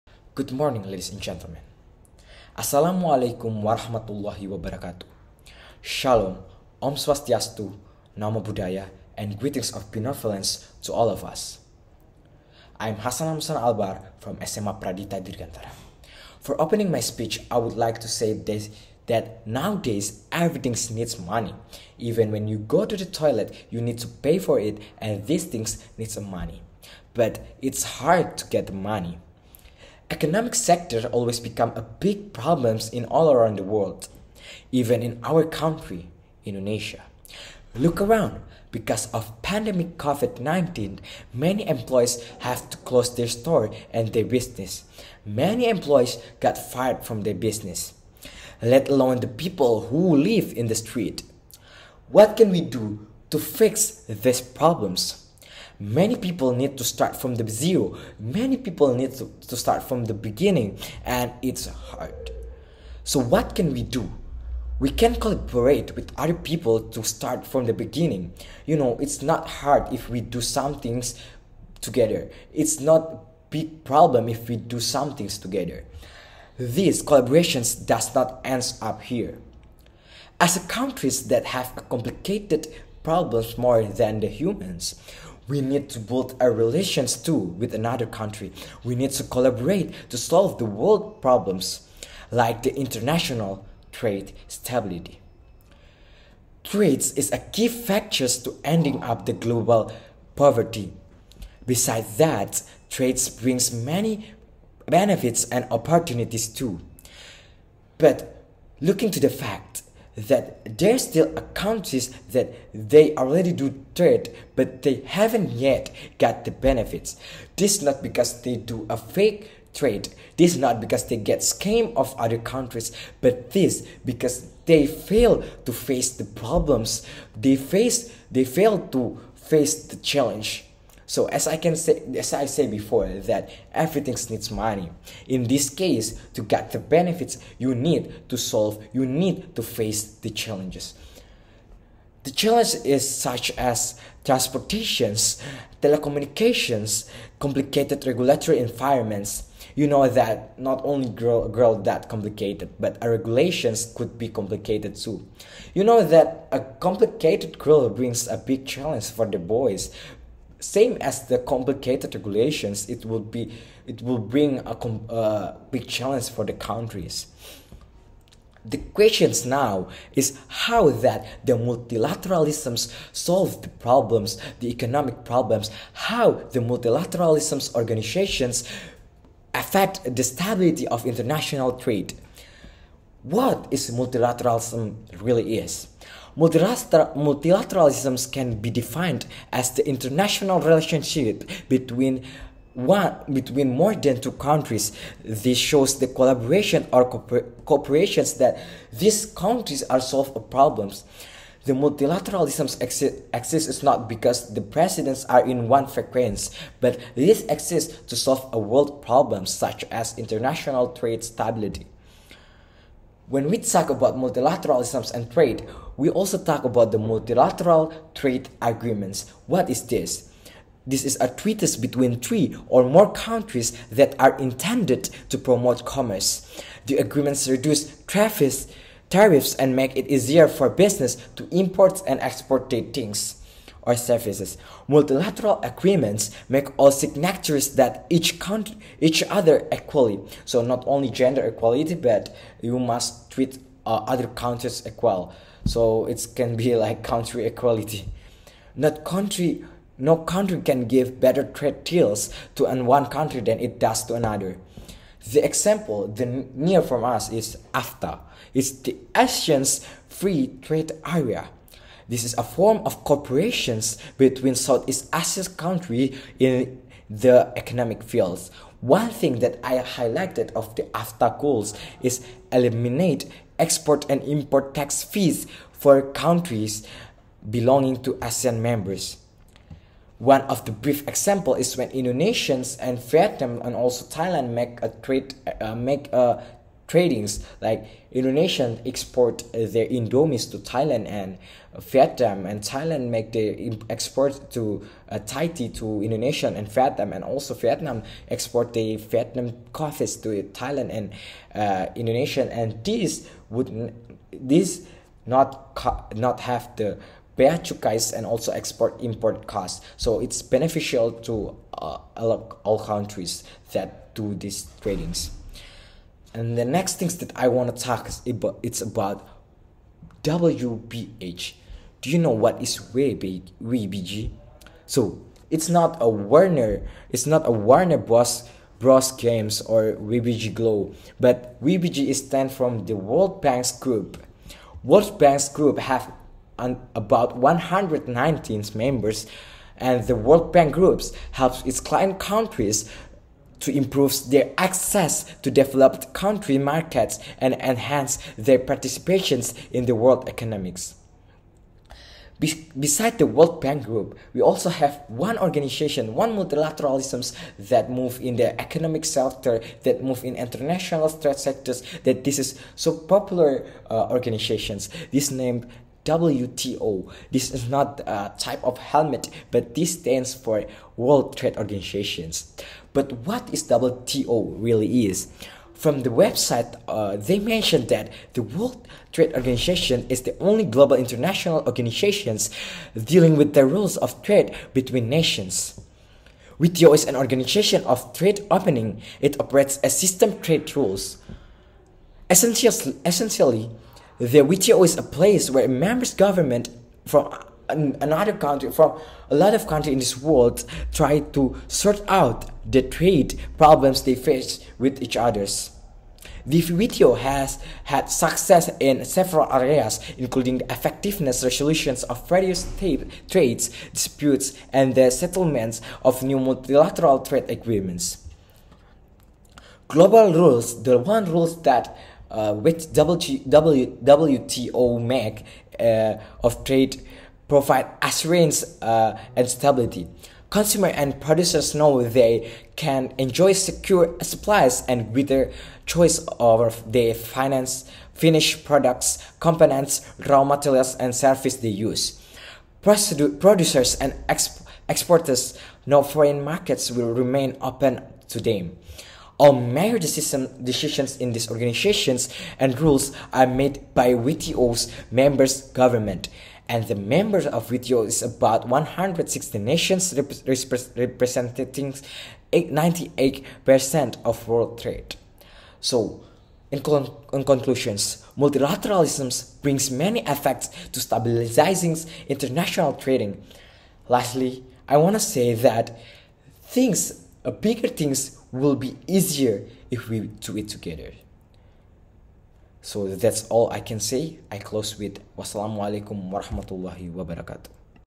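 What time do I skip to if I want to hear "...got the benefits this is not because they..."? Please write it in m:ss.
1:56.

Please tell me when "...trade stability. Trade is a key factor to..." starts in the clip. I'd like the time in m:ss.
1:33.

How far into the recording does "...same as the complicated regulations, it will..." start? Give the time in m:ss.
2:40.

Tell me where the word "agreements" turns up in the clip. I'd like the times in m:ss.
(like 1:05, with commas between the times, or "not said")
3:38, 3:46, 3:55, 6:57.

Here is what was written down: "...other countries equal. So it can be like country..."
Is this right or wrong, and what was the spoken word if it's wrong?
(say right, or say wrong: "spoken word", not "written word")
right.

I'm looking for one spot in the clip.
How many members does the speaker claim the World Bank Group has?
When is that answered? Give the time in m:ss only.
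5:37.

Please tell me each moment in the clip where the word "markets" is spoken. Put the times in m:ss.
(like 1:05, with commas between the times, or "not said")
5:46, 7:26.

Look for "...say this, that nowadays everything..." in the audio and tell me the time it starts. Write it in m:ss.
0:18.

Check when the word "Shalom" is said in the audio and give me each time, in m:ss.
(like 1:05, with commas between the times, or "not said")
0:05.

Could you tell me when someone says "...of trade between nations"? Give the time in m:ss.
6:23.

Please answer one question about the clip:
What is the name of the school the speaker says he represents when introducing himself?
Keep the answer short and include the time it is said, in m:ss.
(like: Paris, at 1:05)
SMA Pradita Dirgantara, at 0:14.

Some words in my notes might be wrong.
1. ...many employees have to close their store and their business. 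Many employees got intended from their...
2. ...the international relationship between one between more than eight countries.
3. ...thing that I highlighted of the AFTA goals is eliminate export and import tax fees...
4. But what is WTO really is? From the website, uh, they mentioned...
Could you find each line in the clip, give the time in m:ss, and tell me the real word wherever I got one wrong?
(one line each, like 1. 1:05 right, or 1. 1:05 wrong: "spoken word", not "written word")
1. 0:41 wrong: "fired", not "intended"
2. 3:09 wrong: "two", not "eight"
3. 4:29 right
4. 6:12 right.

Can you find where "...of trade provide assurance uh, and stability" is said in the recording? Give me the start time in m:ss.
7:06.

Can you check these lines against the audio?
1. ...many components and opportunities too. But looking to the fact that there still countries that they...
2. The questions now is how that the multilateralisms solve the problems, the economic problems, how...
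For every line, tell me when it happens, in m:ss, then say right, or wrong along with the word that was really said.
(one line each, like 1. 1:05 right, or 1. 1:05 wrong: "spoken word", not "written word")
1. 1:43 wrong: "benefits", not "components"
2. 2:48 right.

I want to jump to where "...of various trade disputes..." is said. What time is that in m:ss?
6:52.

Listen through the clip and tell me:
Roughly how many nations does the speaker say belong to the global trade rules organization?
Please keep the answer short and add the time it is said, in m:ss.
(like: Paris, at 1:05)
160, at 7:38.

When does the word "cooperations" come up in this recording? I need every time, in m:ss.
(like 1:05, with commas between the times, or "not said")
3:17, 4:23.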